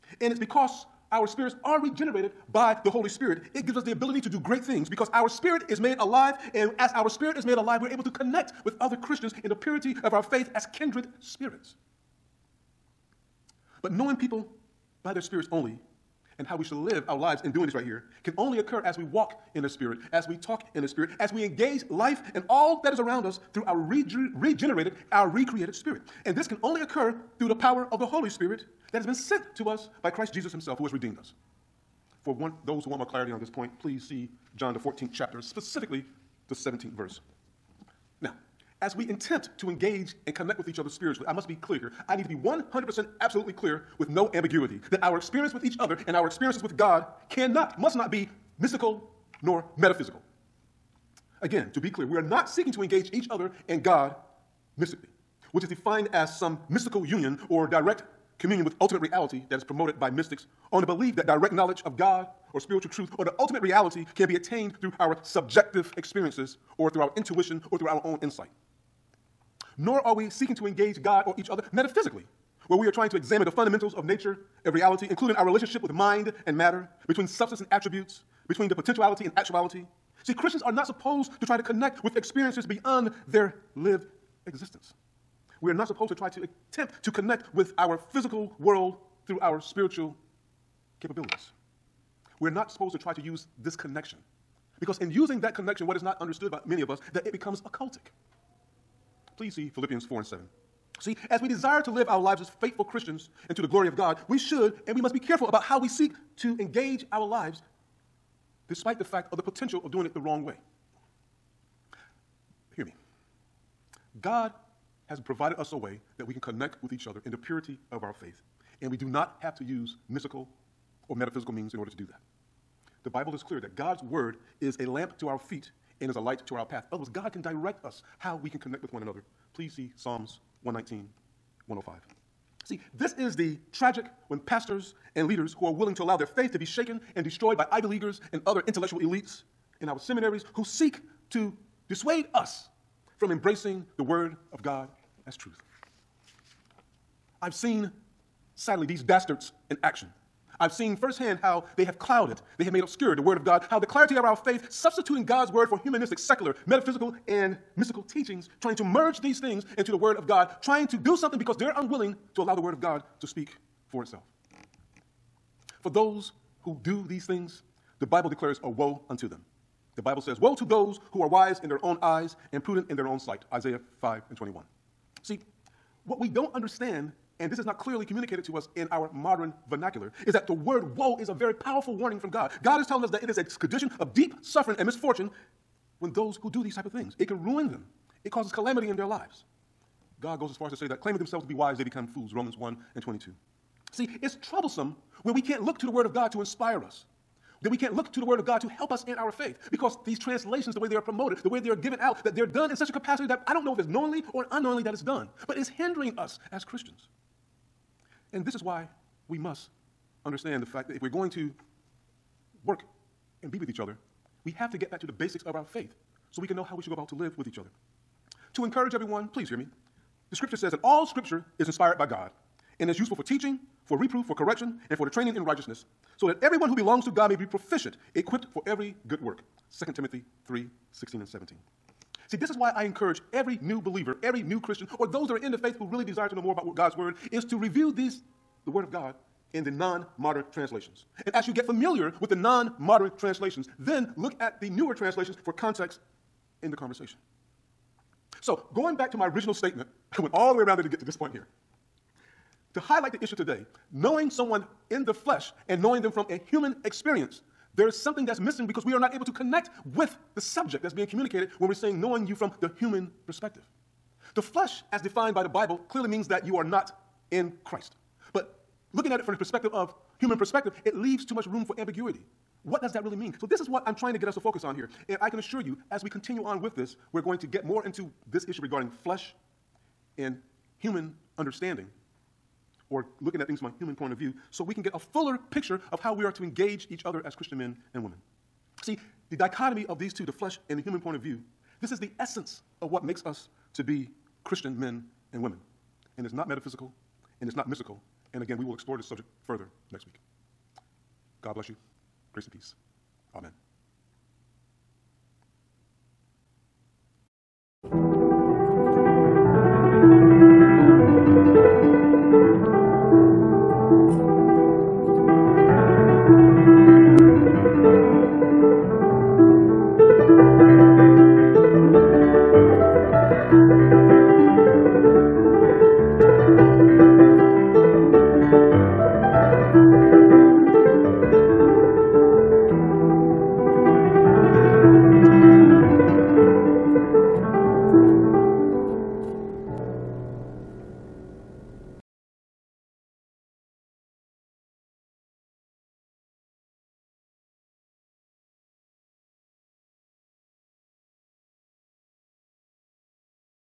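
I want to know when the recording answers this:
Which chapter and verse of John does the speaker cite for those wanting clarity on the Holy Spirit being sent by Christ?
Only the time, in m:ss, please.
0:34.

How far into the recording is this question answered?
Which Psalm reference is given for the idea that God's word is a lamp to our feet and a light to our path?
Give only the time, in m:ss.
2:09.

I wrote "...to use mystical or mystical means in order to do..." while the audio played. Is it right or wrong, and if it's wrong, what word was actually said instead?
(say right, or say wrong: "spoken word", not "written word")
wrong: "metaphysical", not "mystical".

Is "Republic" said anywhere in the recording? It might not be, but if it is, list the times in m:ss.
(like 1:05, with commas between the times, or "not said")
not said.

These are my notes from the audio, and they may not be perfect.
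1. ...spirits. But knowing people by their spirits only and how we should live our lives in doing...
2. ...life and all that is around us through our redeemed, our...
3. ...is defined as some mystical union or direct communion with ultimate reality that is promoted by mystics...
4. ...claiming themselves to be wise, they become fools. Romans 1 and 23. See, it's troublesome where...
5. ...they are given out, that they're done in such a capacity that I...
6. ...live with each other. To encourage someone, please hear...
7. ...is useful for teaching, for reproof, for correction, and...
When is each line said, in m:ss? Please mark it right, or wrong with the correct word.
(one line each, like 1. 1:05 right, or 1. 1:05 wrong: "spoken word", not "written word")
1. 0:11 right
2. 0:21 wrong: "regenerated", not "redeemed"
3. 0:55 right
4. 3:11 wrong: "22", not "23"
5. 3:21 right
6. 3:37 wrong: "everyone", not "someone"
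7. 3:42 right.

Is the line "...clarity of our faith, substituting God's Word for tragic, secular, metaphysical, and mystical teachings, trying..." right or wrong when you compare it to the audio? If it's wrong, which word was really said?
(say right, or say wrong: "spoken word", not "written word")
wrong: "humanistic", not "tragic".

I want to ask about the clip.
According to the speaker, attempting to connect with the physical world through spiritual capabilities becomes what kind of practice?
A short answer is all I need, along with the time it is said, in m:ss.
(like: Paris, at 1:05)
Occultic, at 1:37.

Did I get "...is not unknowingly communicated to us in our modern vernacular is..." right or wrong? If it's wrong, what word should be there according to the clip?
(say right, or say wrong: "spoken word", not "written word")
wrong: "clearly", not "unknowingly".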